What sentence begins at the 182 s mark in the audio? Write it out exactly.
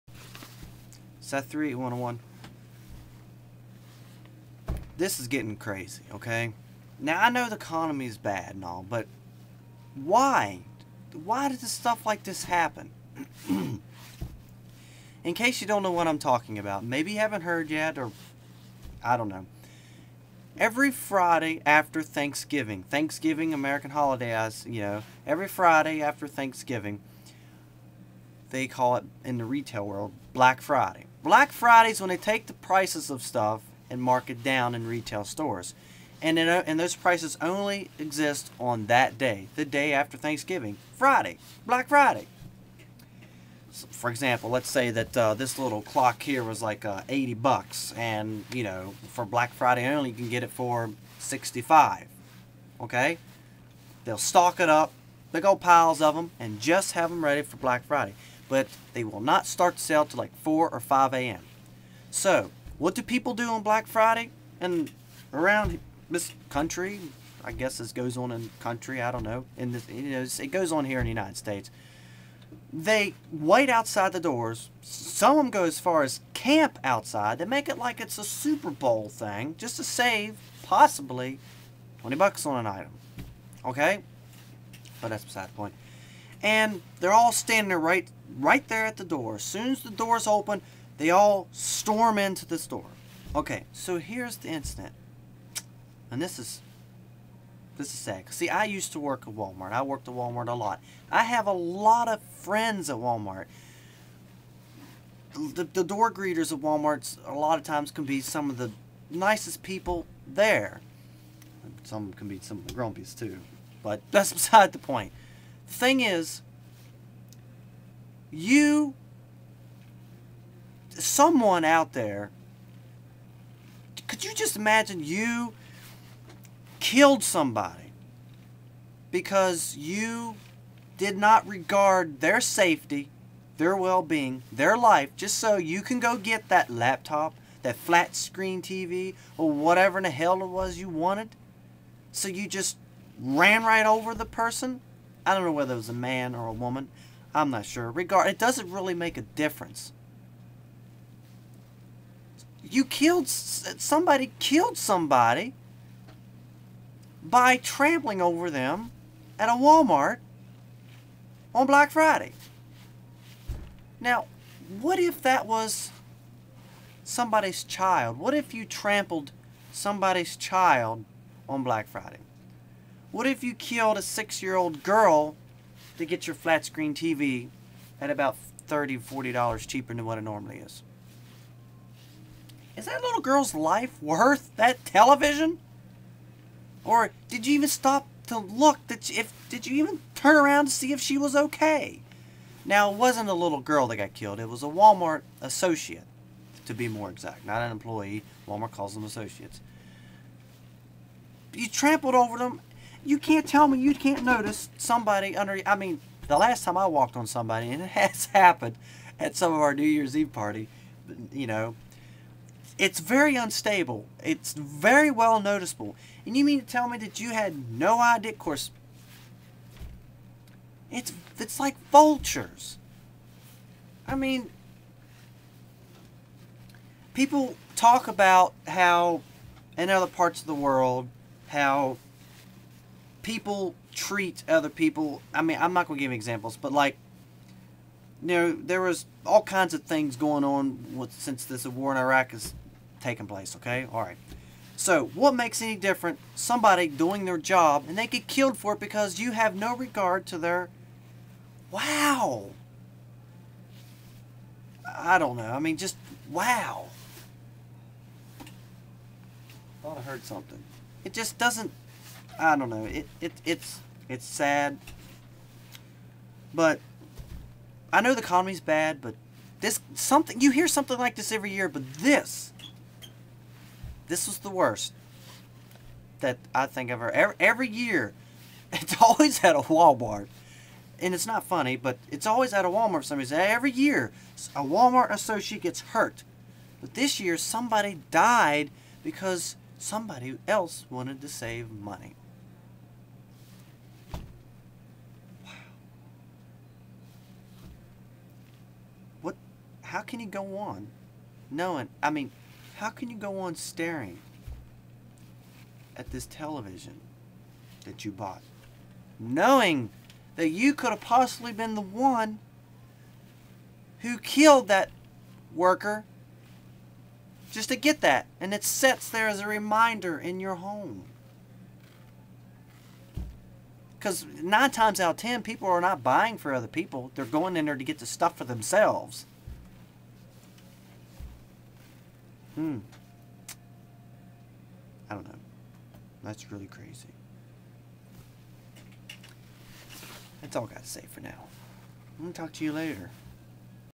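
Is that little girl's life worth that television?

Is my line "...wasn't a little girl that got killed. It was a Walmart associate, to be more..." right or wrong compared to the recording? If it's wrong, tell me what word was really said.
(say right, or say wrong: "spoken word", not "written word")
right.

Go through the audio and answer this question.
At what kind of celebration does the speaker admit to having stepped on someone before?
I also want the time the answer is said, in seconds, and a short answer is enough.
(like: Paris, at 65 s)
New Year's Eve party, at 209 s.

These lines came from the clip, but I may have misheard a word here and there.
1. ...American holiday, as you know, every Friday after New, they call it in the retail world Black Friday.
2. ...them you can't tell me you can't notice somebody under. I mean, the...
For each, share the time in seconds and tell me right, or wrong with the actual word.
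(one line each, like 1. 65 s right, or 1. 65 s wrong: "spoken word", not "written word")
1. 23 s wrong: "Thanksgiving", not "New"
2. 202 s right.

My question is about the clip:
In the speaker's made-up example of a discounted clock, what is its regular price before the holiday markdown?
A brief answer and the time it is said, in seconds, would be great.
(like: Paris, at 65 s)
$80, at 47 s.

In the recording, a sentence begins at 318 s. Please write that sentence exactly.
And it sits there as a reminder in your home.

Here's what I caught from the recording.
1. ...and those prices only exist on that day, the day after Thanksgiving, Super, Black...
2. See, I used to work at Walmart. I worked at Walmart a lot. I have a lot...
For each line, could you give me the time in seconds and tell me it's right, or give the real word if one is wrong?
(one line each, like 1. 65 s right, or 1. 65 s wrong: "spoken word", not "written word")
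1. 36 s wrong: "Friday", not "Super"
2. 98 s right.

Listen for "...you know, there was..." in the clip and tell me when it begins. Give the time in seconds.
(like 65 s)
238 s.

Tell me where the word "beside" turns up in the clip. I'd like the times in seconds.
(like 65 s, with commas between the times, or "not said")
85 s, 114 s.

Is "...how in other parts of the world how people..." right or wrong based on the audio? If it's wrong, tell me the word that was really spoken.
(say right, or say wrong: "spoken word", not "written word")
right.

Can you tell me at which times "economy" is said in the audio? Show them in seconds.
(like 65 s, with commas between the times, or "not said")
7 s, 268 s.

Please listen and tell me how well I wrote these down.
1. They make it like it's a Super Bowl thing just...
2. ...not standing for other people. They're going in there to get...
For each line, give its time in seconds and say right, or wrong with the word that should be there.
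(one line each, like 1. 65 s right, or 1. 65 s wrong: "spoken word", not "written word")
1. 77 s right
2. 325 s wrong: "buying", not "standing".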